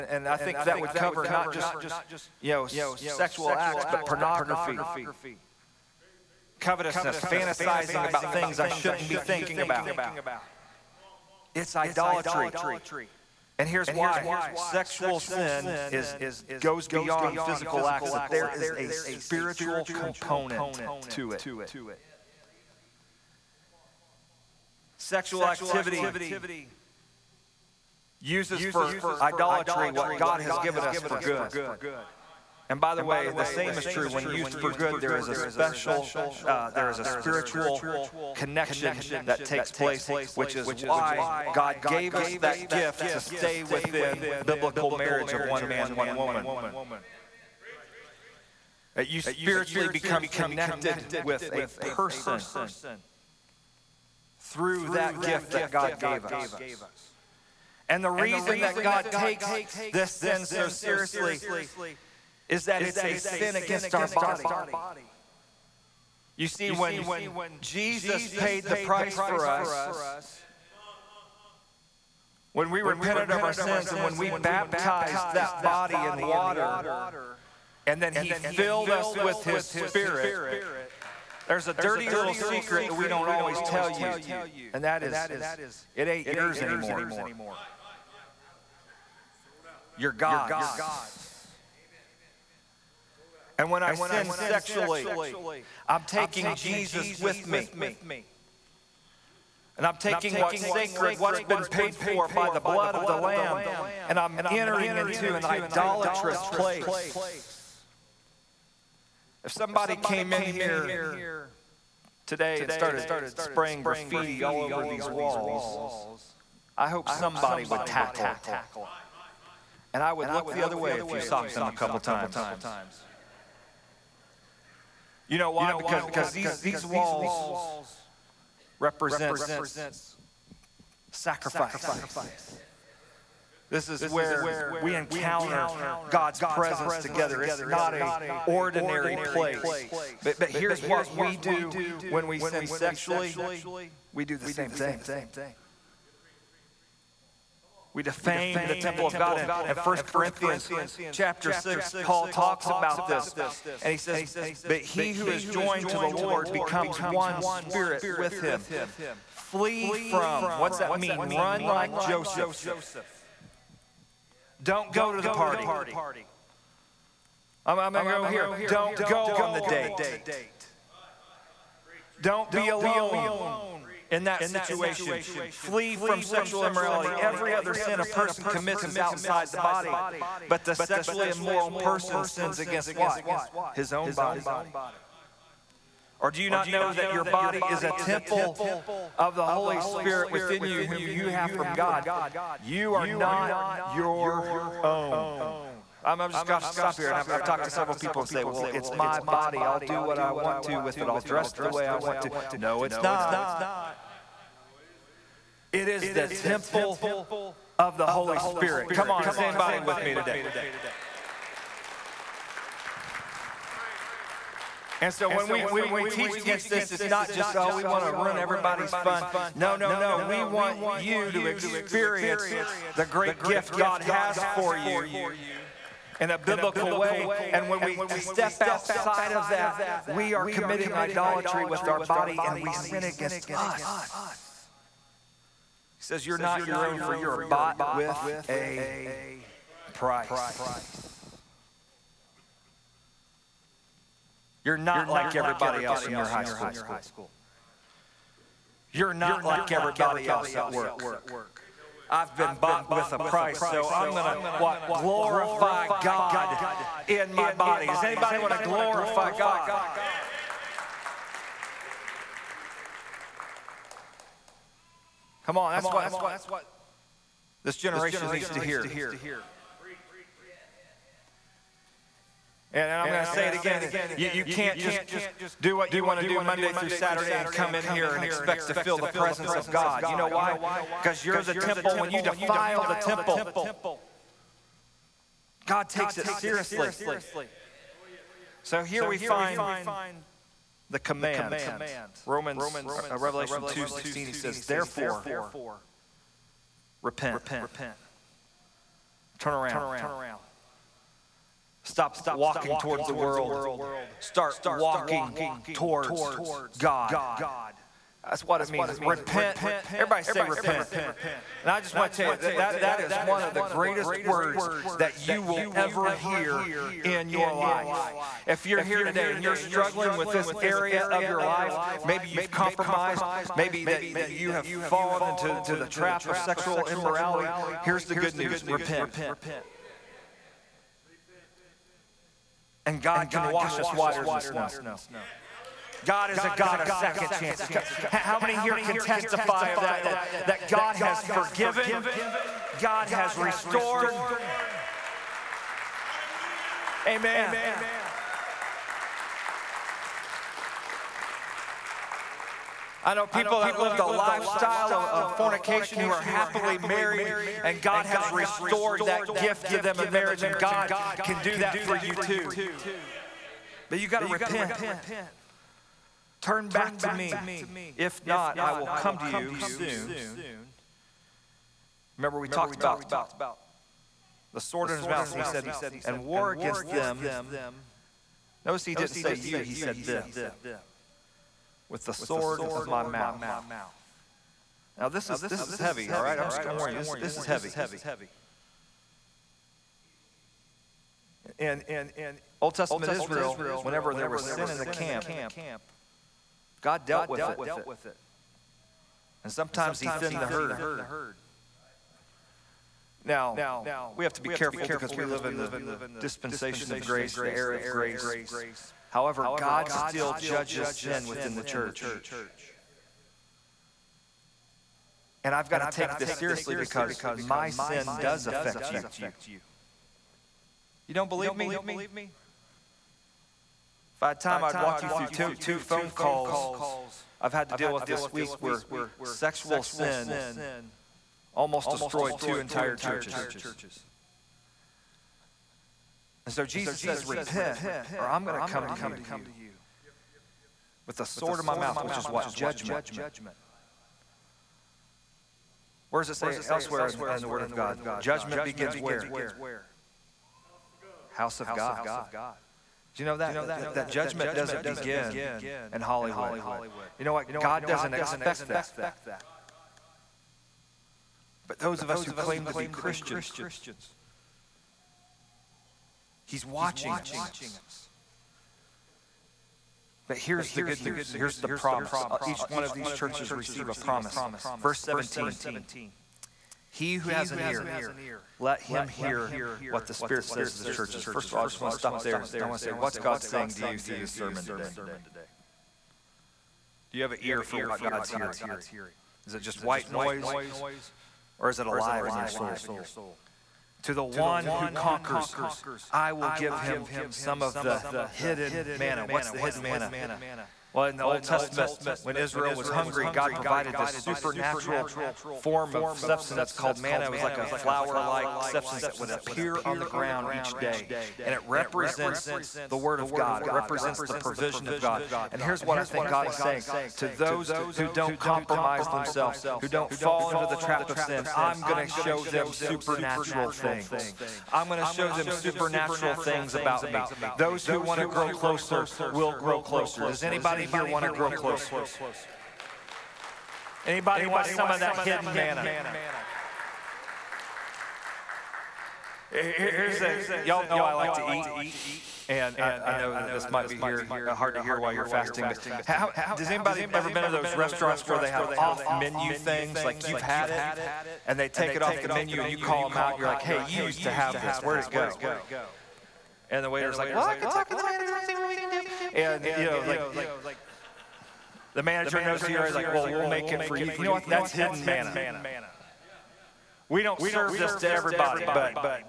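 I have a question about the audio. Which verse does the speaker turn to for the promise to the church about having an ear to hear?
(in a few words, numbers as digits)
17.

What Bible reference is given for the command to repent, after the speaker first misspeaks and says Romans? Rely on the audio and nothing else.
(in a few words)
Revelation 2:16.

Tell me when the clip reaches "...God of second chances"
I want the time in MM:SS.
05:36.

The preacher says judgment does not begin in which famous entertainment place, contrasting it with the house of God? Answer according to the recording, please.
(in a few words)
Hollywood.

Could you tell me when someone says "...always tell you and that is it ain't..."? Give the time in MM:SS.
01:23.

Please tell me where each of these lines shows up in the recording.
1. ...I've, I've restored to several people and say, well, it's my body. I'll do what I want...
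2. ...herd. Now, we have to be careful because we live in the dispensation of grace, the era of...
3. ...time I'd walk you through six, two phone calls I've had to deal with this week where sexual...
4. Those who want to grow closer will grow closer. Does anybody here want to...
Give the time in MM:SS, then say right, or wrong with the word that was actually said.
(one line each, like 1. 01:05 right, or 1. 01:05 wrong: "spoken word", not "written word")
1. 03:17 wrong: "talked", not "restored"
2. 06:40 right
3. 07:04 wrong: "two", not "six"
4. 08:47 right.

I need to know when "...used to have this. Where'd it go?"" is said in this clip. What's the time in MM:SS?
09:13.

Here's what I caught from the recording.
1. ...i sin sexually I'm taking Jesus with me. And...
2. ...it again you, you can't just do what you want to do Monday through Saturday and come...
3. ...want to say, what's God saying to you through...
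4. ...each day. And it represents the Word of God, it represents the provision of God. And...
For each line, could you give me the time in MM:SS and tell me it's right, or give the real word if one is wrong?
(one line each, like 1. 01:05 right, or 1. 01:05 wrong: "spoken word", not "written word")
1. 01:33 right
2. 04:33 right
3. 08:02 right
4. 08:30 right.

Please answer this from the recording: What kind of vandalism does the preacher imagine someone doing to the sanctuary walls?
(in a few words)
Spraying graffiti.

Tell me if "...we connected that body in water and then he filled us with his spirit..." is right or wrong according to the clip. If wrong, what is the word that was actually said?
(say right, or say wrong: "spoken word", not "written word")
wrong: "baptized", not "connected".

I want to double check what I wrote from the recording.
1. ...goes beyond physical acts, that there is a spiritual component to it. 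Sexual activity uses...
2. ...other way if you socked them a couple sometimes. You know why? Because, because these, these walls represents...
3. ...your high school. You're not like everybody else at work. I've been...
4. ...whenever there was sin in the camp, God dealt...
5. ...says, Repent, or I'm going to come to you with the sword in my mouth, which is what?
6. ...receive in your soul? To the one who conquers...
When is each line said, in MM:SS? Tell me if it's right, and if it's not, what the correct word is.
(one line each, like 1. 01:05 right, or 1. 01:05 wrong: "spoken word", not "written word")
1. 00:16 right
2. 02:00 wrong: "times", not "sometimes"
3. 04:06 right
4. 06:33 right
5. 07:16 right
6. 08:11 wrong: "alive", not "receive".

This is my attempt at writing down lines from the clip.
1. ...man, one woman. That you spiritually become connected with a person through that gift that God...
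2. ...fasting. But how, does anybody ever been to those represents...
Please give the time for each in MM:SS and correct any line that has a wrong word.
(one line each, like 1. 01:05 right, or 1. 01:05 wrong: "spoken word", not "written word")
1. 00:45 right
2. 09:05 wrong: "restaurants", not "represents".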